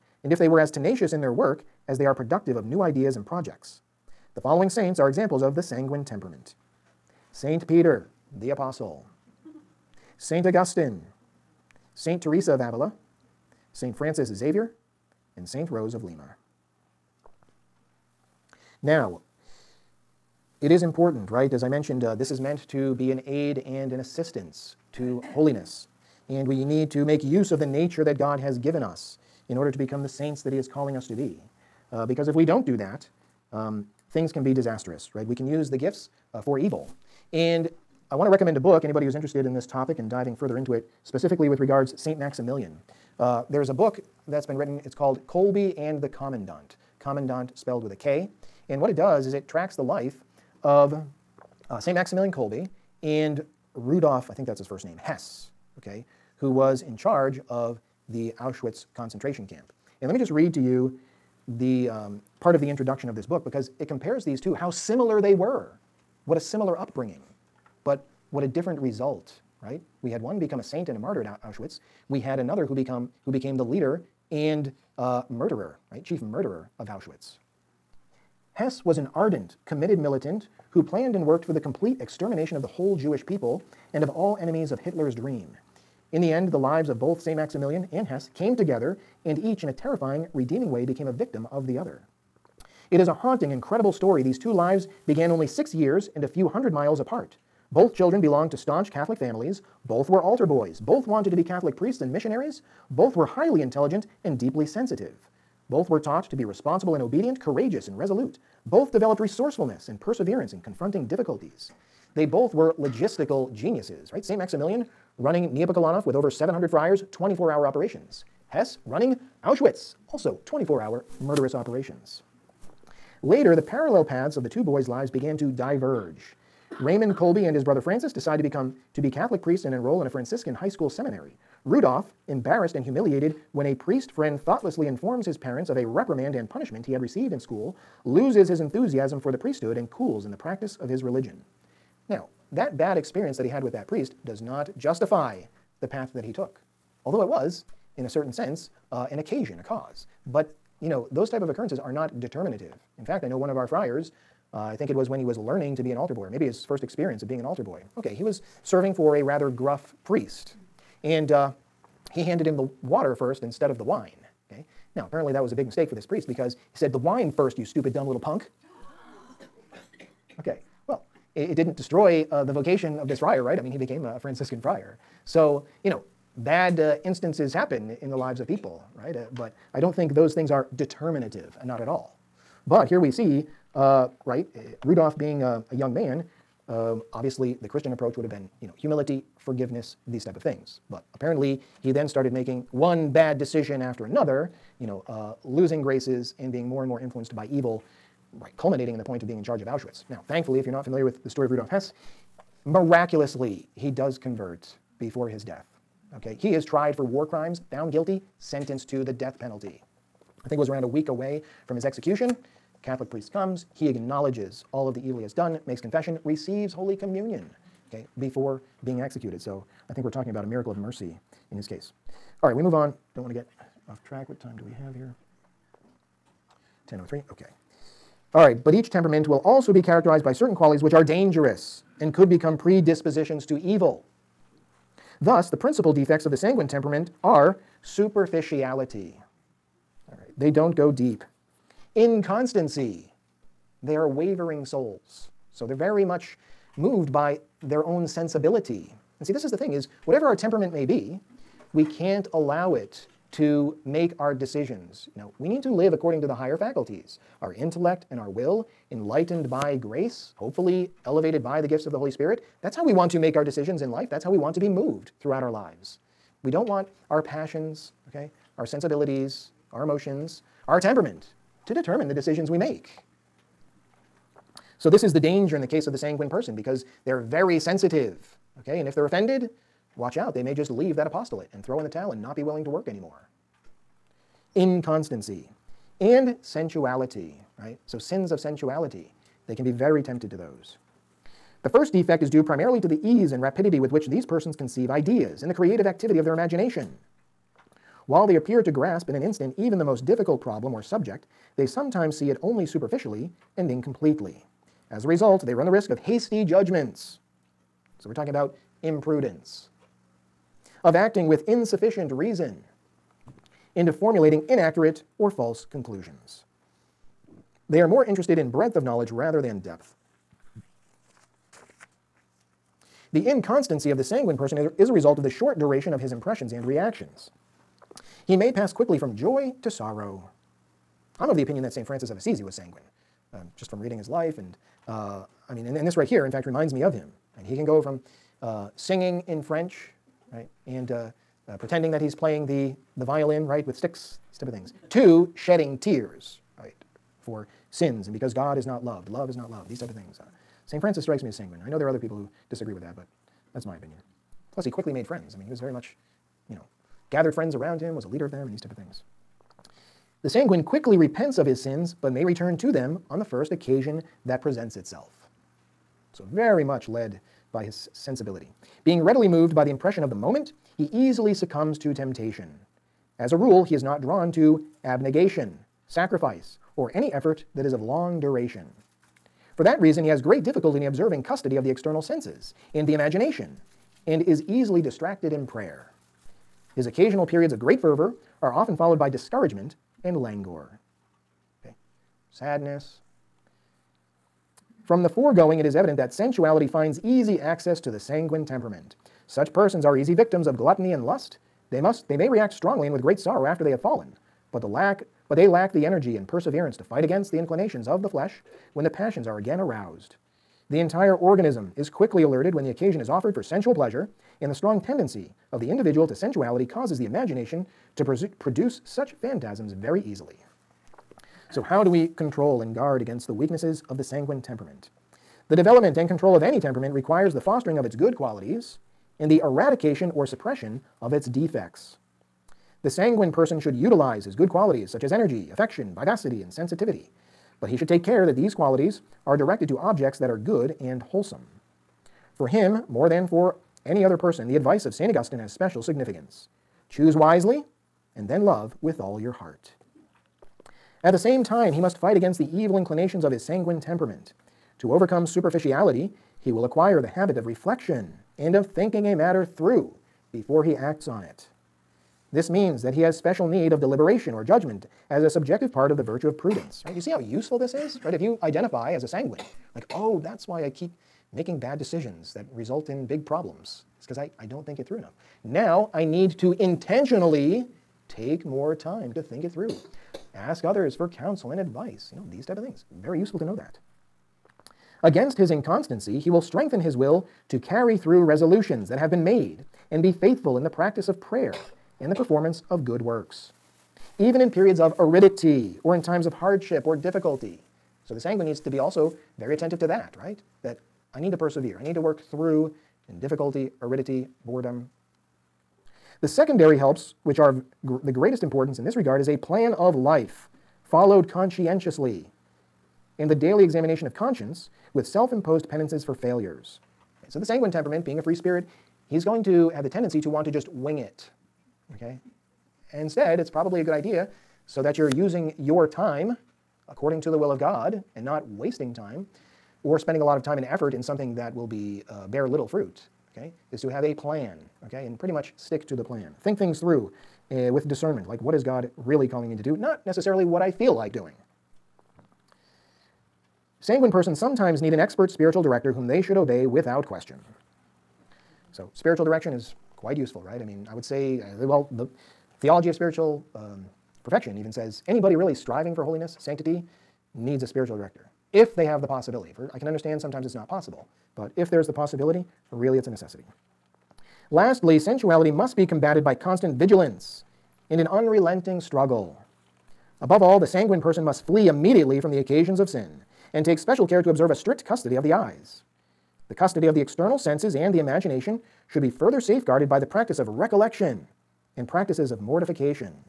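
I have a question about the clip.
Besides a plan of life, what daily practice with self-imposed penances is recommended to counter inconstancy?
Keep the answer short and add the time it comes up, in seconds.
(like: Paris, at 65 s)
Examination of conscience, at 513 s.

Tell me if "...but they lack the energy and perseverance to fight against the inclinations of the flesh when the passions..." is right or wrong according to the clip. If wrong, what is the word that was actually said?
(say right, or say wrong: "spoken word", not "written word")
right.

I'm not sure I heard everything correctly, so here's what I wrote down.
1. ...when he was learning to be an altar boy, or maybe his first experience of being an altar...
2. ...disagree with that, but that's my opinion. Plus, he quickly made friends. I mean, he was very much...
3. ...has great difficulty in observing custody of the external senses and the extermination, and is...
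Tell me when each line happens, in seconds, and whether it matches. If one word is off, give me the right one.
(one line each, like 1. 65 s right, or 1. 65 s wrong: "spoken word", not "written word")
1. 155 s right
2. 352 s right
3. 380 s wrong: "imagination", not "extermination".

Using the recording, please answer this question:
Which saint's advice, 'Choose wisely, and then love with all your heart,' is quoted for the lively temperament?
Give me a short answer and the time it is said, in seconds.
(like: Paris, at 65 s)
St. Augustine, at 444 s.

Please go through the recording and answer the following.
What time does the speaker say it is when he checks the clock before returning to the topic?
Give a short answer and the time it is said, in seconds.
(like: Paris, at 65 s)
10:03, at 226 s.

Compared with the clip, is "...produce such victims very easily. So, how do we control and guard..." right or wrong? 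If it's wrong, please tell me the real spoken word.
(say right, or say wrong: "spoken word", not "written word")
wrong: "phantasms", not "victims".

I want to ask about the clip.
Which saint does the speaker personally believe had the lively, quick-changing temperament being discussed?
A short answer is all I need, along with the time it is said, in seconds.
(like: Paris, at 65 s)
St. Francis of Assisi, at 331 s.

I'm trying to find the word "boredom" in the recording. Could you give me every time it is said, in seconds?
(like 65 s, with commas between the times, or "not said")
504 s.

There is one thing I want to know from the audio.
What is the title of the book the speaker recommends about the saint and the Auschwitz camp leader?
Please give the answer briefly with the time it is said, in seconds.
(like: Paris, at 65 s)
Kolbe and the Kommandant, at 45 s.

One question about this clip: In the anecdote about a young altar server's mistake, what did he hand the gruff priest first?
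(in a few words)
The water.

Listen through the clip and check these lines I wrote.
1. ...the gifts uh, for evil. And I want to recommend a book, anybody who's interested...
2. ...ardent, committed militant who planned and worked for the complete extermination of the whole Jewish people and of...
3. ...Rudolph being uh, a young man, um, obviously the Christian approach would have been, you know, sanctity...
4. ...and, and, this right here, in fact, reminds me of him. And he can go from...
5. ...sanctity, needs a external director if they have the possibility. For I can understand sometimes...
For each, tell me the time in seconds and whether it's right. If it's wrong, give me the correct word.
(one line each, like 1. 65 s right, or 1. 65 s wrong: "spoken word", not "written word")
1. 35 s right
2. 79 s right
3. 184 s wrong: "humility", not "sanctity"
4. 335 s right
5. 556 s wrong: "spiritual", not "external".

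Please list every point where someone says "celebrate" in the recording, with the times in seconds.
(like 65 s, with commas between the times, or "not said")
not said.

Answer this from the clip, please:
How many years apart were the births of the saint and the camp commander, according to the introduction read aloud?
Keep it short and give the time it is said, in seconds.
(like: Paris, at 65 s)
6, at 95 s.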